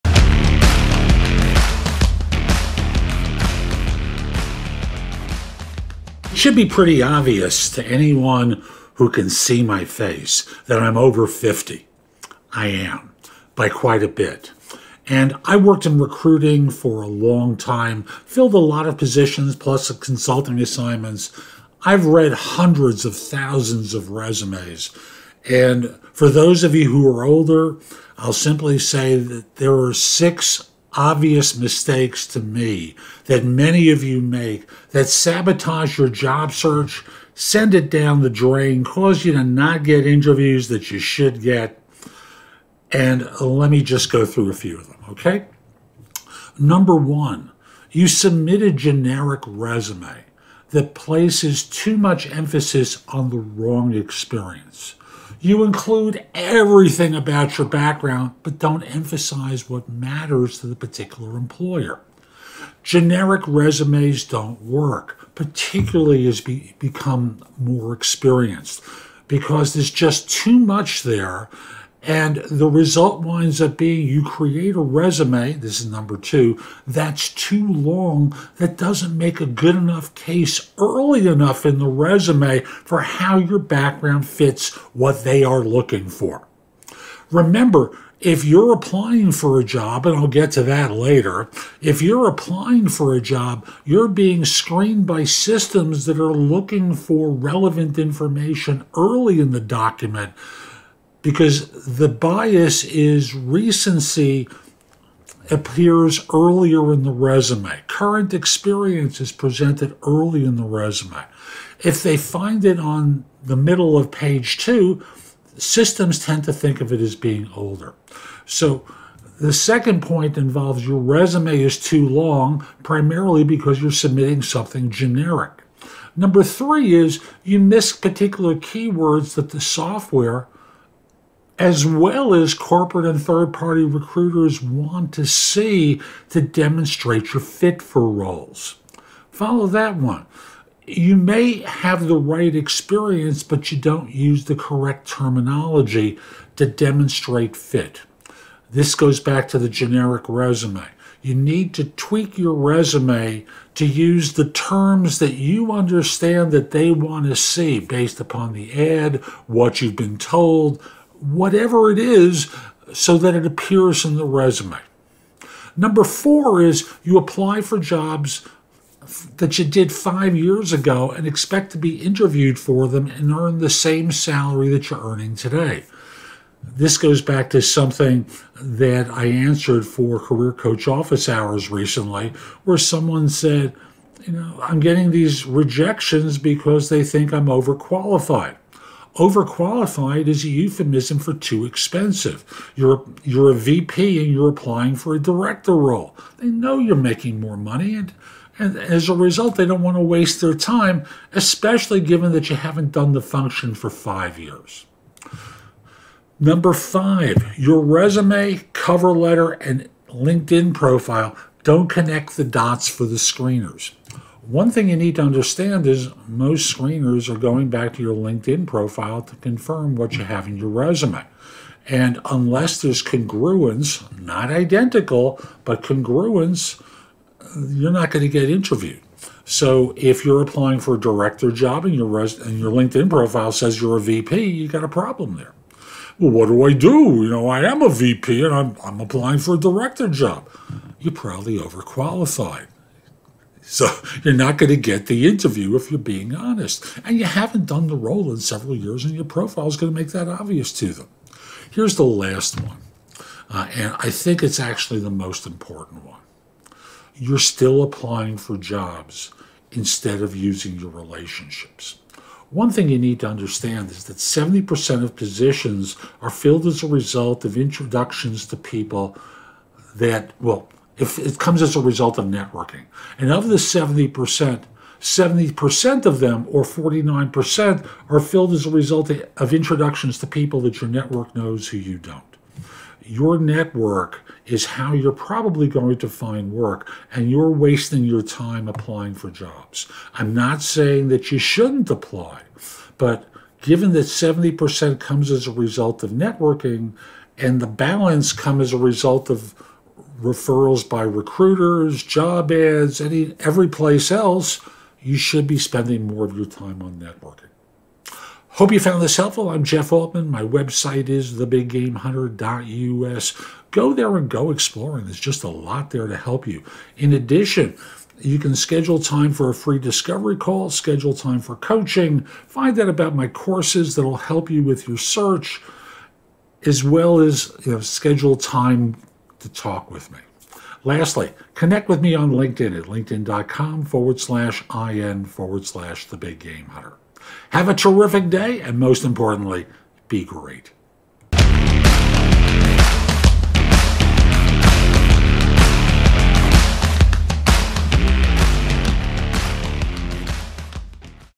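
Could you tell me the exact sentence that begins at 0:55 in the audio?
You include everything about your background, but don't emphasize what matters to the particular employer.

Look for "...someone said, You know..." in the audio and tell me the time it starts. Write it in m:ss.
3:02.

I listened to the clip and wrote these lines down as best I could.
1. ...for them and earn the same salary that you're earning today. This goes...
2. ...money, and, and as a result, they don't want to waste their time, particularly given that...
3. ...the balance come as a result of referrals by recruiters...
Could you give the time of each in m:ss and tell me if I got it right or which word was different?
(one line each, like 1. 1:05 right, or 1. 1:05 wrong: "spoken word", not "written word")
1. 2:52 right
2. 3:17 wrong: "especially", not "particularly"
3. 4:57 right.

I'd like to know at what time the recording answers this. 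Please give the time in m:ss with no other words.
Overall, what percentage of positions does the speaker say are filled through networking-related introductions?
4:24.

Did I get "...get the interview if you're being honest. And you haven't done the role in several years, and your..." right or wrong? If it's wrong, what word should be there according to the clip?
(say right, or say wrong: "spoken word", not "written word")
right.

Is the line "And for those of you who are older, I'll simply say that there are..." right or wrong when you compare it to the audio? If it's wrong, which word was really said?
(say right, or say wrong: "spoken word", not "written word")
right.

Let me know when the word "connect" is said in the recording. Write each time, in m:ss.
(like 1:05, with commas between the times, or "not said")
3:31, 5:31.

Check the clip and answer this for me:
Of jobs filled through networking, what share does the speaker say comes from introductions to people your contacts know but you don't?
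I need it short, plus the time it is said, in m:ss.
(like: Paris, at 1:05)
49%, at 4:36.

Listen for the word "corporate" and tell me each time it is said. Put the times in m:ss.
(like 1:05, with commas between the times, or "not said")
2:12.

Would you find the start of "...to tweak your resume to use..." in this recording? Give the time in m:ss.
2:31.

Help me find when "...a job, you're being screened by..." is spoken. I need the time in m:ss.
1:33.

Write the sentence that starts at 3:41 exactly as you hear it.
And unless there's congruence, not identical, but congruence, you're not going to get interviewed.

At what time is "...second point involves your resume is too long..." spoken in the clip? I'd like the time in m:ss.
1:59.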